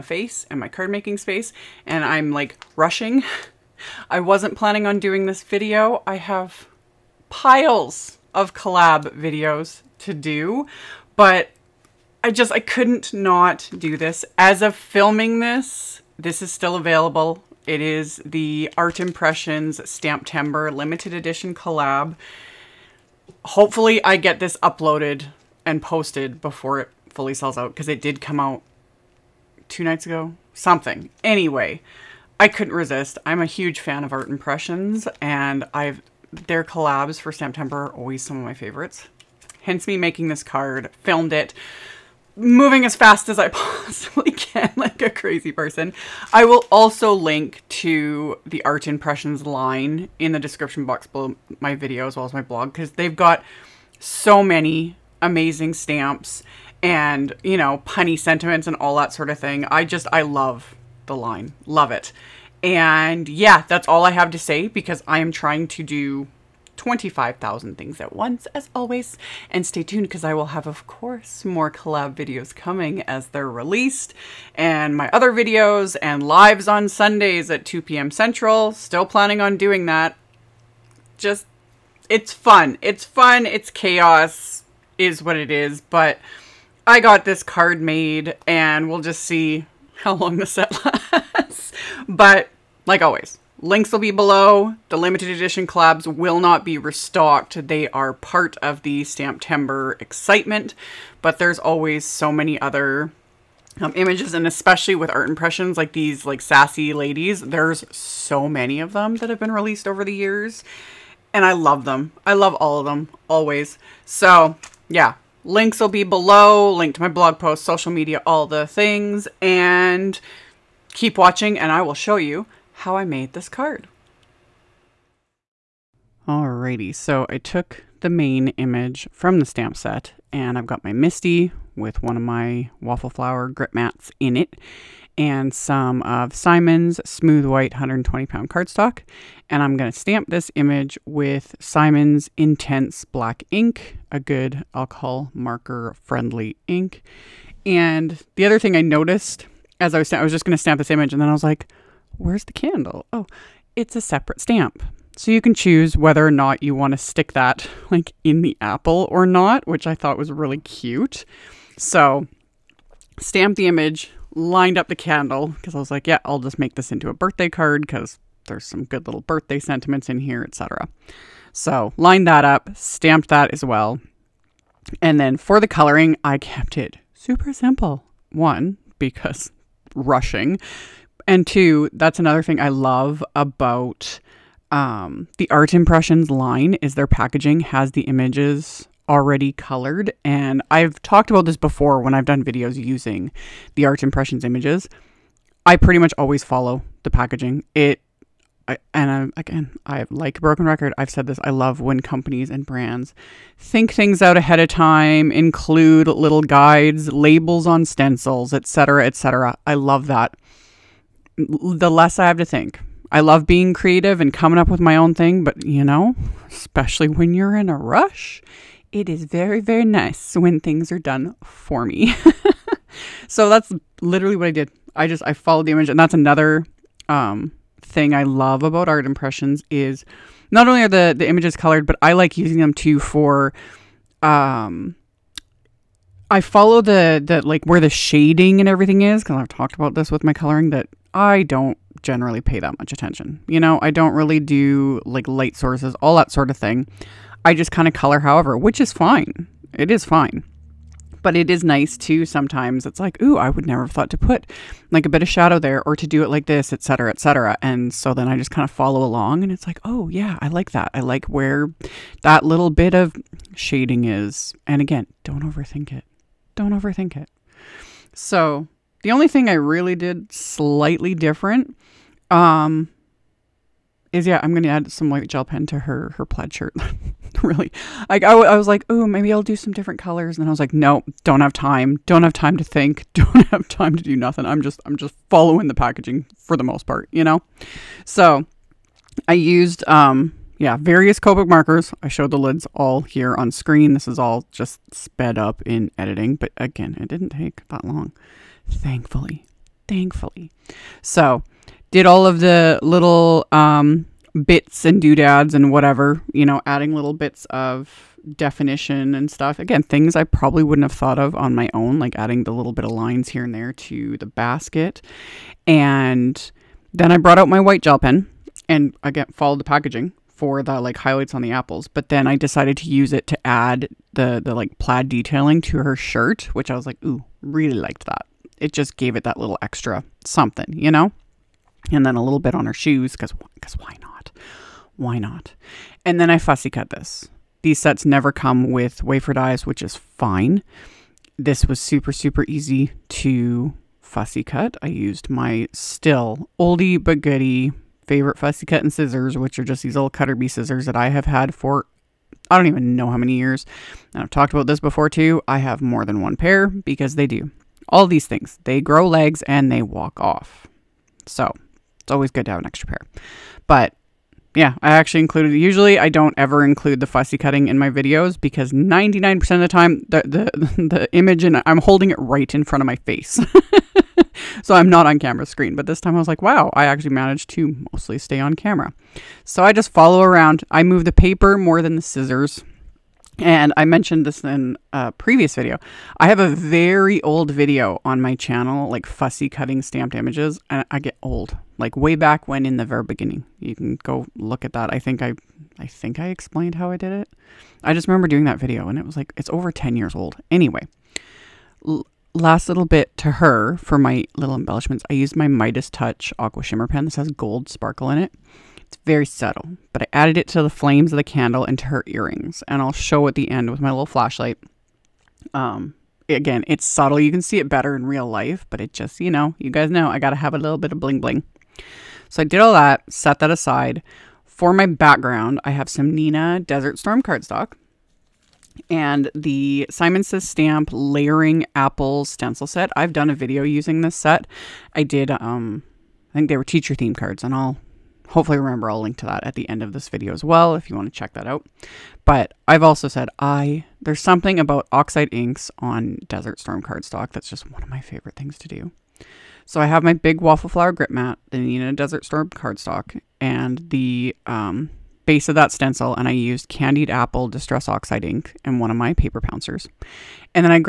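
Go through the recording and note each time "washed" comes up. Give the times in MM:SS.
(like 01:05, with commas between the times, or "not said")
not said.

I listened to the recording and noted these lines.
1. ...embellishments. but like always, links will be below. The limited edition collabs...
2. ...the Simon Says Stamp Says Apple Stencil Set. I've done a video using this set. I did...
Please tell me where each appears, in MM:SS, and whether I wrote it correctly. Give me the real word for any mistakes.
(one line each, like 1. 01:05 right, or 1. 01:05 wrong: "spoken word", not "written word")
1. 01:31 wrong: "lasts", not "embellishments"
2. 07:09 wrong: "Layering", not "Says".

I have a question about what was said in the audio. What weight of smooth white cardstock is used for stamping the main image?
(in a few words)
120 pound.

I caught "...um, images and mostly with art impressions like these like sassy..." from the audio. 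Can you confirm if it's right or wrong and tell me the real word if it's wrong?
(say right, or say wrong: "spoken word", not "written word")
wrong: "especially", not "mostly".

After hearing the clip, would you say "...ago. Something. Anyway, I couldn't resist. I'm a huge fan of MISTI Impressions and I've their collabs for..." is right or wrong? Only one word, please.
wrong.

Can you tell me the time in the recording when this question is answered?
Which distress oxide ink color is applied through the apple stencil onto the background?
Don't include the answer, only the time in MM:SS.
07:36.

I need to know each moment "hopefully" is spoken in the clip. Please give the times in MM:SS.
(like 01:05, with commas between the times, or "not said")
00:23, 07:18.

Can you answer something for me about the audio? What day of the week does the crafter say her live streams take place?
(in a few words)
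Sundays.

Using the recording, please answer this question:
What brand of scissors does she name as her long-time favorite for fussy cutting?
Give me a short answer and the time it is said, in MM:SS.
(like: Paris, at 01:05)
Cutter Bee, at 05:50.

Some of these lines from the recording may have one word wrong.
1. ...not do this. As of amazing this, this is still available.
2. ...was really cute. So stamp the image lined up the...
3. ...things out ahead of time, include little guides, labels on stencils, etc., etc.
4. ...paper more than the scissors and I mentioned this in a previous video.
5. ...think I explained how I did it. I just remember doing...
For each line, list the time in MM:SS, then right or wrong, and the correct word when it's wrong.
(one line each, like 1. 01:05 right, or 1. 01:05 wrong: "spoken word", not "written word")
1. 00:13 wrong: "filming", not "amazing"
2. 02:40 right
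3. 03:23 right
4. 06:21 right
5. 06:35 right.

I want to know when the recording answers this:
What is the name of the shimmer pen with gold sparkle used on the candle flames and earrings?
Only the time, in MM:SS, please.
06:45.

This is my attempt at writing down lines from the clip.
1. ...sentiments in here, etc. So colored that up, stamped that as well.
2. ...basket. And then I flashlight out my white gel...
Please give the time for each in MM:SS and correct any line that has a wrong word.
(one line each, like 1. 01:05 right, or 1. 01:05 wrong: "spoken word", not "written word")
1. 02:49 wrong: "lined", not "colored"
2. 05:14 wrong: "brought", not "flashlight".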